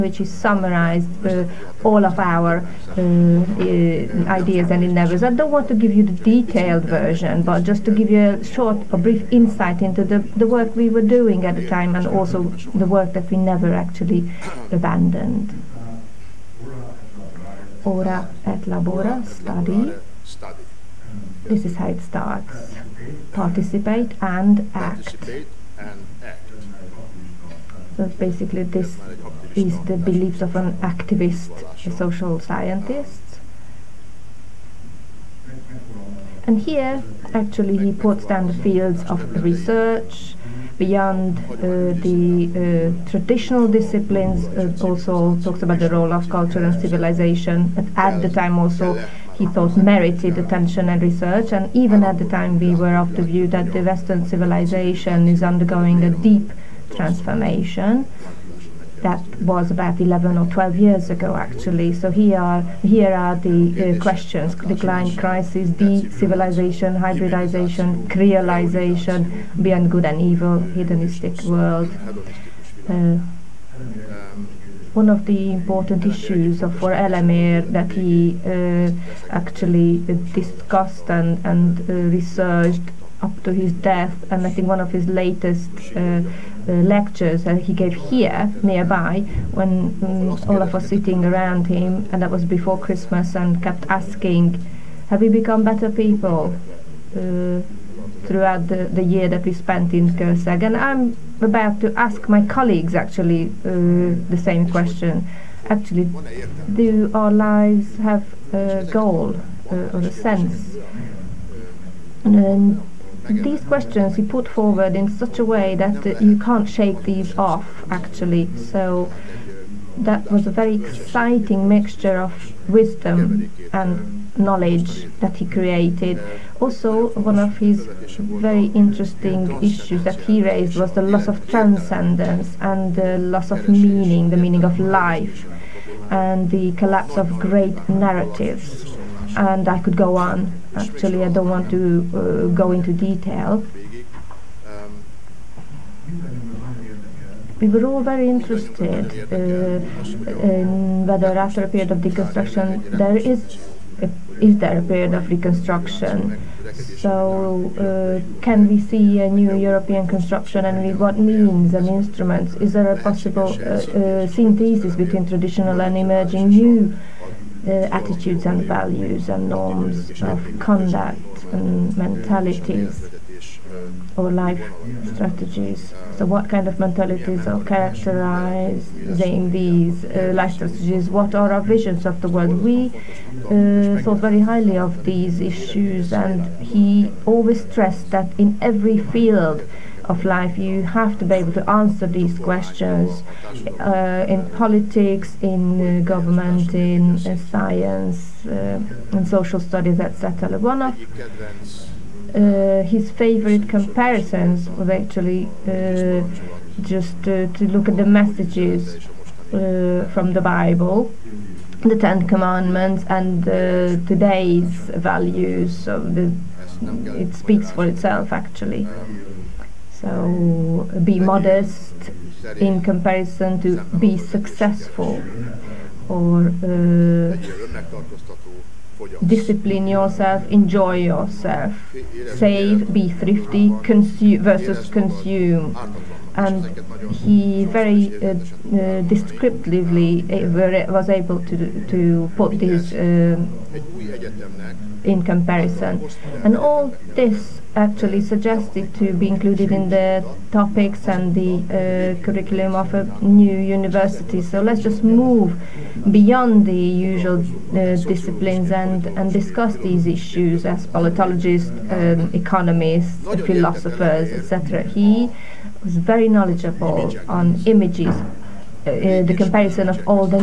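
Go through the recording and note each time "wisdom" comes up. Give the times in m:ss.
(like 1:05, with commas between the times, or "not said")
2:02.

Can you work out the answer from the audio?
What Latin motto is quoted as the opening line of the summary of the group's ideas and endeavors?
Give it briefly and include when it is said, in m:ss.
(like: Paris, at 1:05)
Ora et Labora, at 0:17.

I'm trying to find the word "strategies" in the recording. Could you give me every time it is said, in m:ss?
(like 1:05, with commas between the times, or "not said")
2:55, 3:00.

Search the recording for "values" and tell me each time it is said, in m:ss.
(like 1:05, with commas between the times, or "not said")
2:48, 3:35.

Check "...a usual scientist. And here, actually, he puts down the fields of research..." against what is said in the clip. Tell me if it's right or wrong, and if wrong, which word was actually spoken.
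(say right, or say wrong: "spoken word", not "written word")
wrong: "social", not "usual".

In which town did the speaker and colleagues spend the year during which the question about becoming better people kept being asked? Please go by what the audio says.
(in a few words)
Kőszeg.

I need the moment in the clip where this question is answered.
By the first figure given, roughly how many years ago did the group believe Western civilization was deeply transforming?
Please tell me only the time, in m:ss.
0:59.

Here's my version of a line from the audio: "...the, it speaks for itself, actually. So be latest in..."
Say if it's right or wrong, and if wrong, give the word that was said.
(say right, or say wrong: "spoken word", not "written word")
wrong: "modest", not "latest".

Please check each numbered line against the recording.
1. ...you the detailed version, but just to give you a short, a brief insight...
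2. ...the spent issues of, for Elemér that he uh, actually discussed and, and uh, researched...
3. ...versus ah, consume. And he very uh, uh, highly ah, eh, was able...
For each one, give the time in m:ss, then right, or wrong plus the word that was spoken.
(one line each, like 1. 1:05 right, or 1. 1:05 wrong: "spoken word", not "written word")
1. 0:05 right
2. 1:15 wrong: "important", not "spent"
3. 3:54 wrong: "descriptively", not "highly".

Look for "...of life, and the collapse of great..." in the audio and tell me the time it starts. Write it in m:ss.
2:14.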